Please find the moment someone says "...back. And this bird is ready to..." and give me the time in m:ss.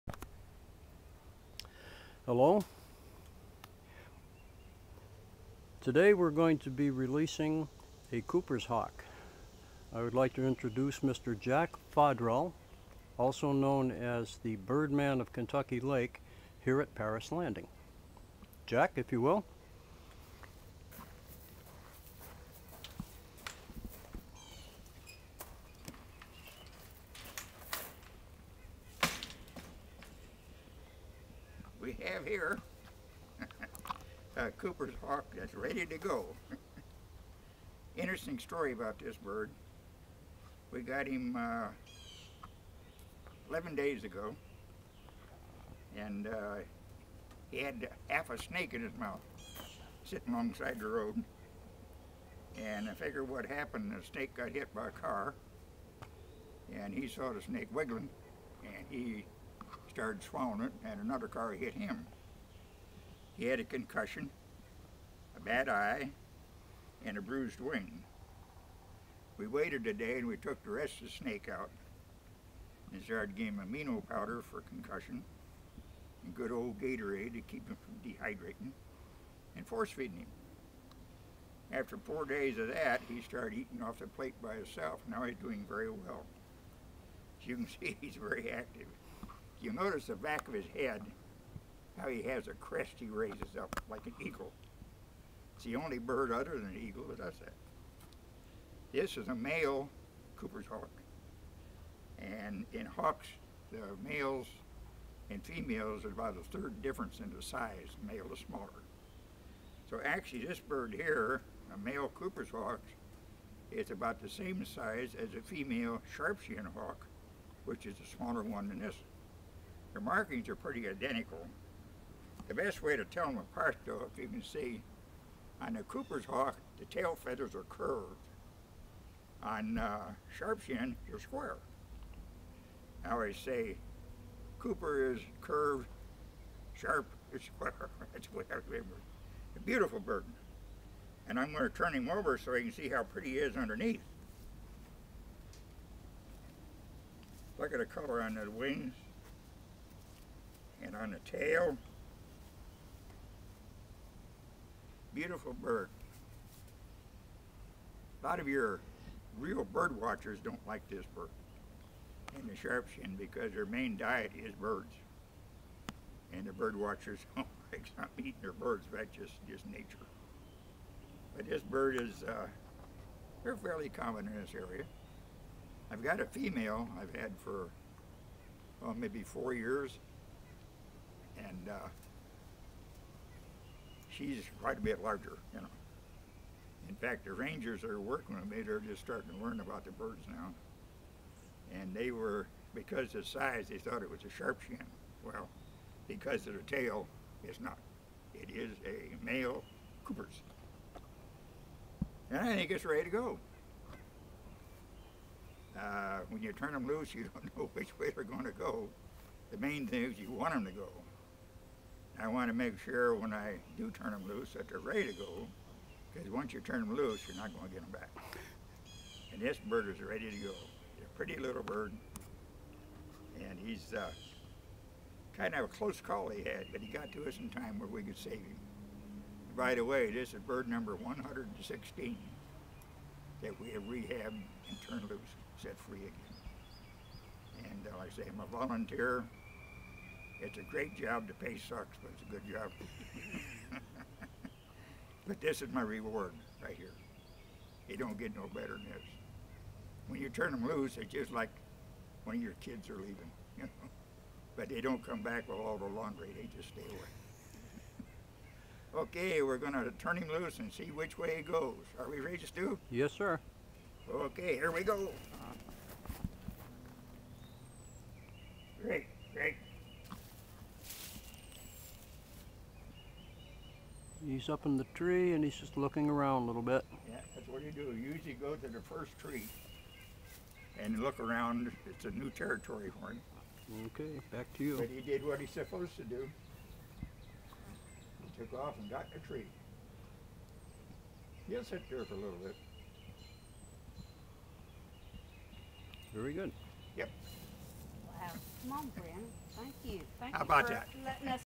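3:37.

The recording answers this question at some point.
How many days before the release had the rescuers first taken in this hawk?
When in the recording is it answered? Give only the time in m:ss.
0:43.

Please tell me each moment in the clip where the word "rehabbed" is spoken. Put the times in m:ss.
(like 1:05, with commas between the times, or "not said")
3:53.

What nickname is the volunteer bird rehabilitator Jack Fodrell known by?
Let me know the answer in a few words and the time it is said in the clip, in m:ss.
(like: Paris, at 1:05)
Birdman of Kentucky Lake, at 0:14.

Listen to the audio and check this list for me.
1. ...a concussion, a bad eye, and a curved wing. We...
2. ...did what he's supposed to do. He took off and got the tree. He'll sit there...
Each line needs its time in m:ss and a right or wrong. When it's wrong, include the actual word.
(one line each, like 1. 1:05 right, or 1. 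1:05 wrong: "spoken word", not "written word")
1. 1:03 wrong: "bruised", not "curved"
2. 4:45 right.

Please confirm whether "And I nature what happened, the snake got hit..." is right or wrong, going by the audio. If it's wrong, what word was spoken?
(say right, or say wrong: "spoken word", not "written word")
wrong: "figure", not "nature".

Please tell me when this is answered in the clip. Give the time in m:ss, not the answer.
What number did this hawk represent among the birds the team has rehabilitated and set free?
3:50.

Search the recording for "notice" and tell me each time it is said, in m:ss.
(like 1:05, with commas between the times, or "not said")
1:29.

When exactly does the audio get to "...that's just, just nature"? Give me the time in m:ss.
2:48.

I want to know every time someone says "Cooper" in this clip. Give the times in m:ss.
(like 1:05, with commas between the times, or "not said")
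0:08, 0:34, 1:40, 1:52, 2:05, 2:14, 3:20.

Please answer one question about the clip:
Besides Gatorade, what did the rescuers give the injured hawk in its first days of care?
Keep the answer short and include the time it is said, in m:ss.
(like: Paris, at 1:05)
amino powder, at 1:13.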